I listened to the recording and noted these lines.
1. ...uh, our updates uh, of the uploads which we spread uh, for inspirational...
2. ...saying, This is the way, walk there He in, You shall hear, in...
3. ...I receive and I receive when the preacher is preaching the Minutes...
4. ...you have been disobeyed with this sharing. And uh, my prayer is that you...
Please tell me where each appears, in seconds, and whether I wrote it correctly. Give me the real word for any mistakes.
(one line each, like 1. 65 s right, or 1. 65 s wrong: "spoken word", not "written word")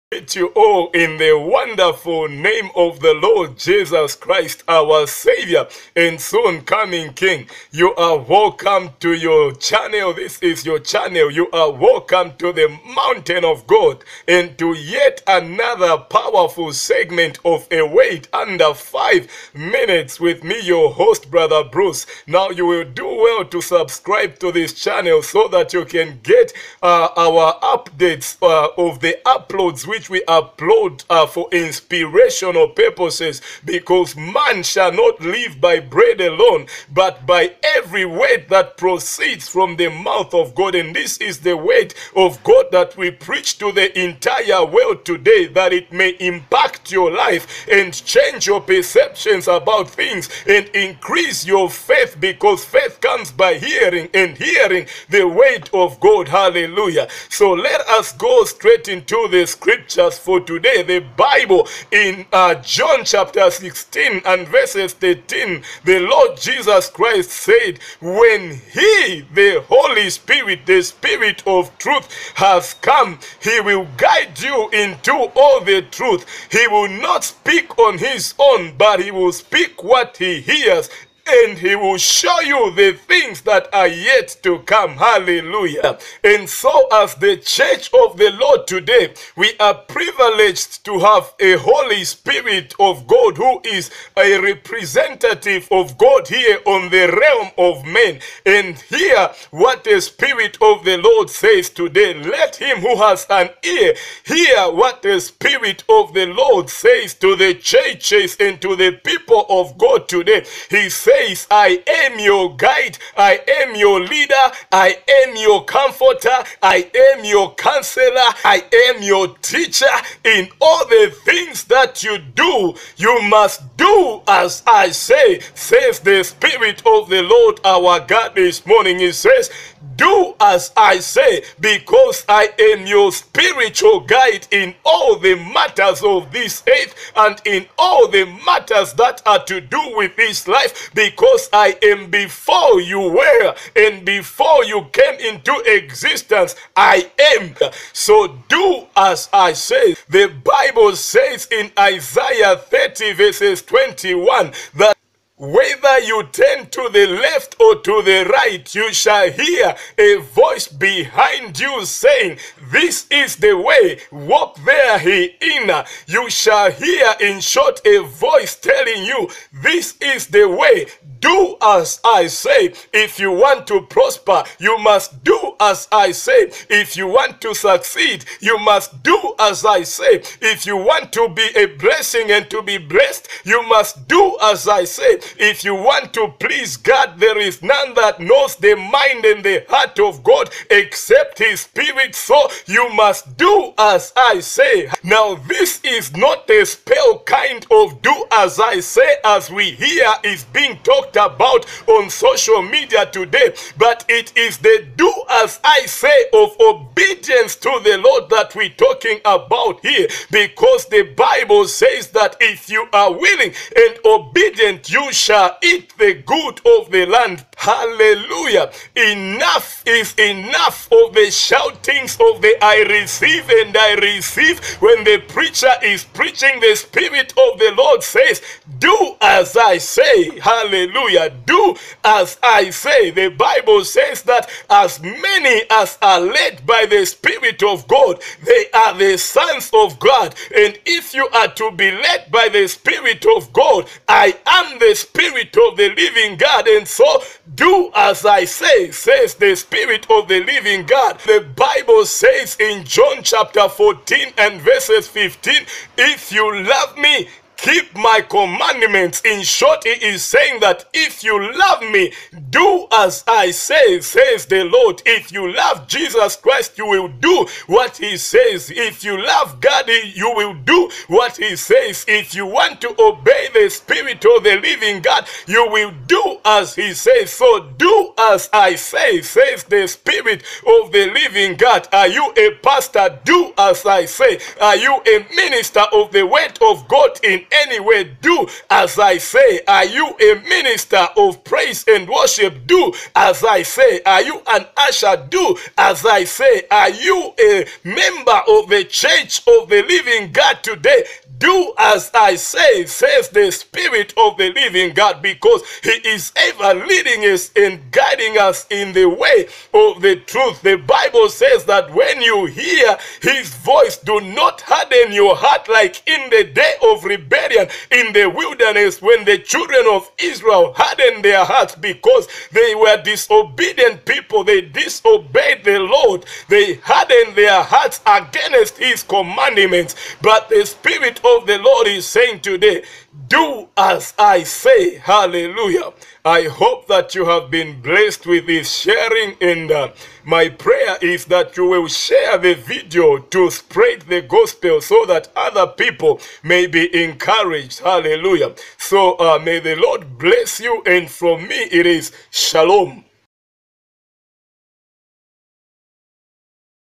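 1. 26 s wrong: "upload", not "spread"
2. 161 s right
3. 222 s wrong: "Spirit", not "Minutes"
4. 337 s wrong: "blessed", not "disobeyed".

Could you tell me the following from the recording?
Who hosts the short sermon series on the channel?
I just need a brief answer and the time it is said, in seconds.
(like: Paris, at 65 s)
Brother Bruce, at 21 s.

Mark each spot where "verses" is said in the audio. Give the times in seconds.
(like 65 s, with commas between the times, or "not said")
64 s, 153 s, 254 s.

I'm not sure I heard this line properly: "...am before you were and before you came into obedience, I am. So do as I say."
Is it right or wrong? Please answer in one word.
wrong.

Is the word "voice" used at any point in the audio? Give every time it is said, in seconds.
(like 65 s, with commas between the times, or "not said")
160 s, 168 s, 313 s.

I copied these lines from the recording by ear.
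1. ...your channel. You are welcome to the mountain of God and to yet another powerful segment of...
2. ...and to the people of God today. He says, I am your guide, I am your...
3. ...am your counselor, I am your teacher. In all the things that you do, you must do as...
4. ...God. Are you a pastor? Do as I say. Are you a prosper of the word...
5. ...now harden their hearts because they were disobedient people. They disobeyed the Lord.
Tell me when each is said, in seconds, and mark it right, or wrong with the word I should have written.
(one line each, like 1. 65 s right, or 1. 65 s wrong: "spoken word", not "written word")
1. 10 s right
2. 108 s right
3. 117 s right
4. 281 s wrong: "minister", not "prosper"
5. 320 s right.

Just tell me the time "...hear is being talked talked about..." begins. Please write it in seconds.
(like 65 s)
199 s.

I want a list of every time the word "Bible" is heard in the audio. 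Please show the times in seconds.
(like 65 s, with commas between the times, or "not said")
61 s, 150 s, 211 s, 233 s, 251 s, 310 s.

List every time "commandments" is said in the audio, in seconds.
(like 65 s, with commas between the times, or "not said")
258 s, 329 s.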